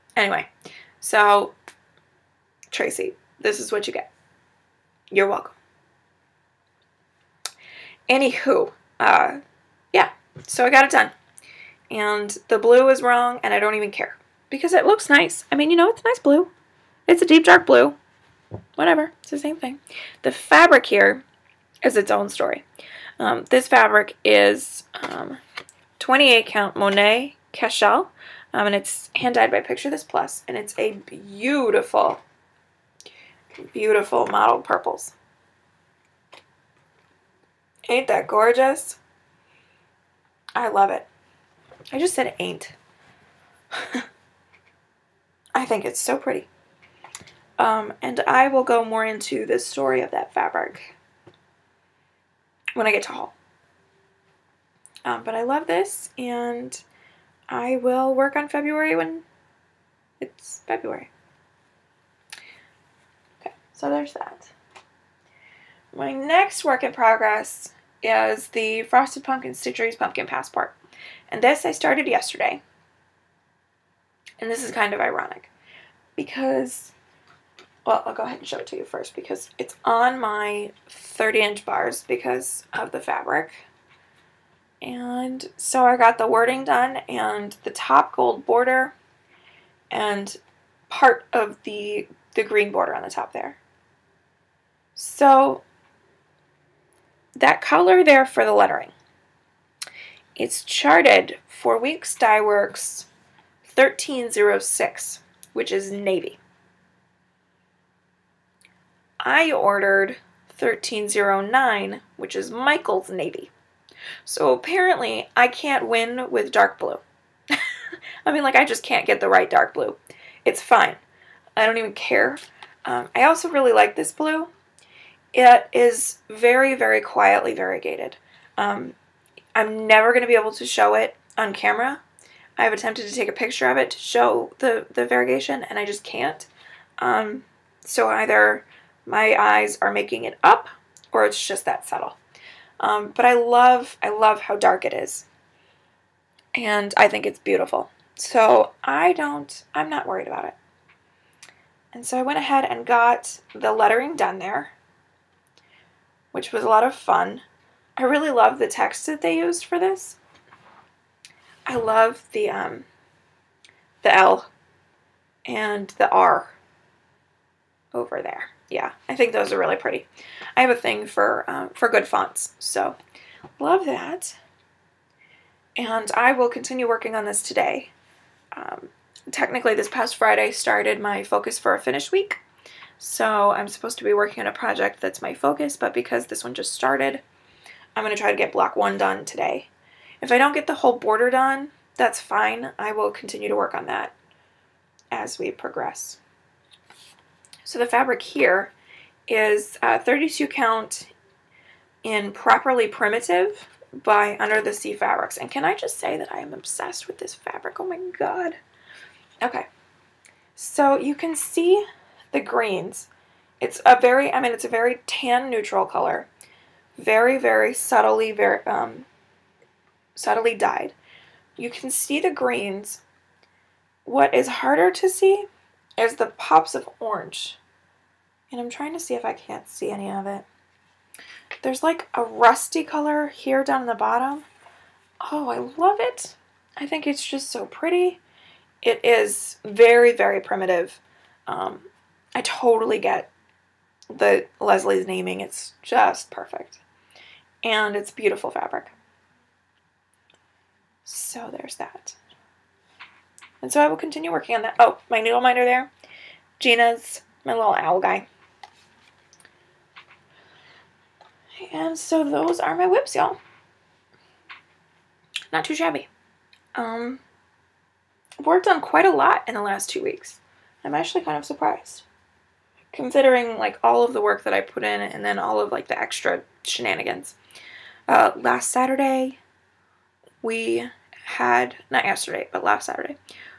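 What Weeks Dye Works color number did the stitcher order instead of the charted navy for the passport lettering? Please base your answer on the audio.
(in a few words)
1309.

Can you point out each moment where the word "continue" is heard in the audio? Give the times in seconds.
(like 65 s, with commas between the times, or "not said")
176 s, 193 s, 253 s.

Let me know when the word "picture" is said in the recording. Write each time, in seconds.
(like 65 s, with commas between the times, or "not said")
29 s, 133 s.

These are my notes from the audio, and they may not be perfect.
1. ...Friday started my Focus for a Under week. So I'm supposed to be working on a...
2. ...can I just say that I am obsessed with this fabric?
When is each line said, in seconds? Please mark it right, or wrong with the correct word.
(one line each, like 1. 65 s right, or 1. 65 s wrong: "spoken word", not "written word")
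1. 180 s wrong: "Finish", not "Under"
2. 205 s right.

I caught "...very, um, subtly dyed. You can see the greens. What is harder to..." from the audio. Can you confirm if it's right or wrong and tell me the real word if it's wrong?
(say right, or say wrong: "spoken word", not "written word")
right.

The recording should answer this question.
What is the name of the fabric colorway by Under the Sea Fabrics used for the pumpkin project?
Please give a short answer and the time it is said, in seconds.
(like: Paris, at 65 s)
Properly Primitive, at 202 s.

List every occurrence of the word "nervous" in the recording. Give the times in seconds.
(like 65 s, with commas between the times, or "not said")
not said.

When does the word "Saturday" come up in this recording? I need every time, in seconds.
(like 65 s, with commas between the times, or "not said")
278 s, 282 s.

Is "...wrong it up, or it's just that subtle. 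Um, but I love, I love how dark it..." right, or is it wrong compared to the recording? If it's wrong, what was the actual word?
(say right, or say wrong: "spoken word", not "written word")
wrong: "making", not "wrong".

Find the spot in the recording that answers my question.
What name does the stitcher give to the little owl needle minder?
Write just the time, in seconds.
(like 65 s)
256 s.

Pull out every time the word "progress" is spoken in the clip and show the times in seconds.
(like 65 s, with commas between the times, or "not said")
66 s, 195 s.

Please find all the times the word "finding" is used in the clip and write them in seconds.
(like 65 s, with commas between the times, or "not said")
not said.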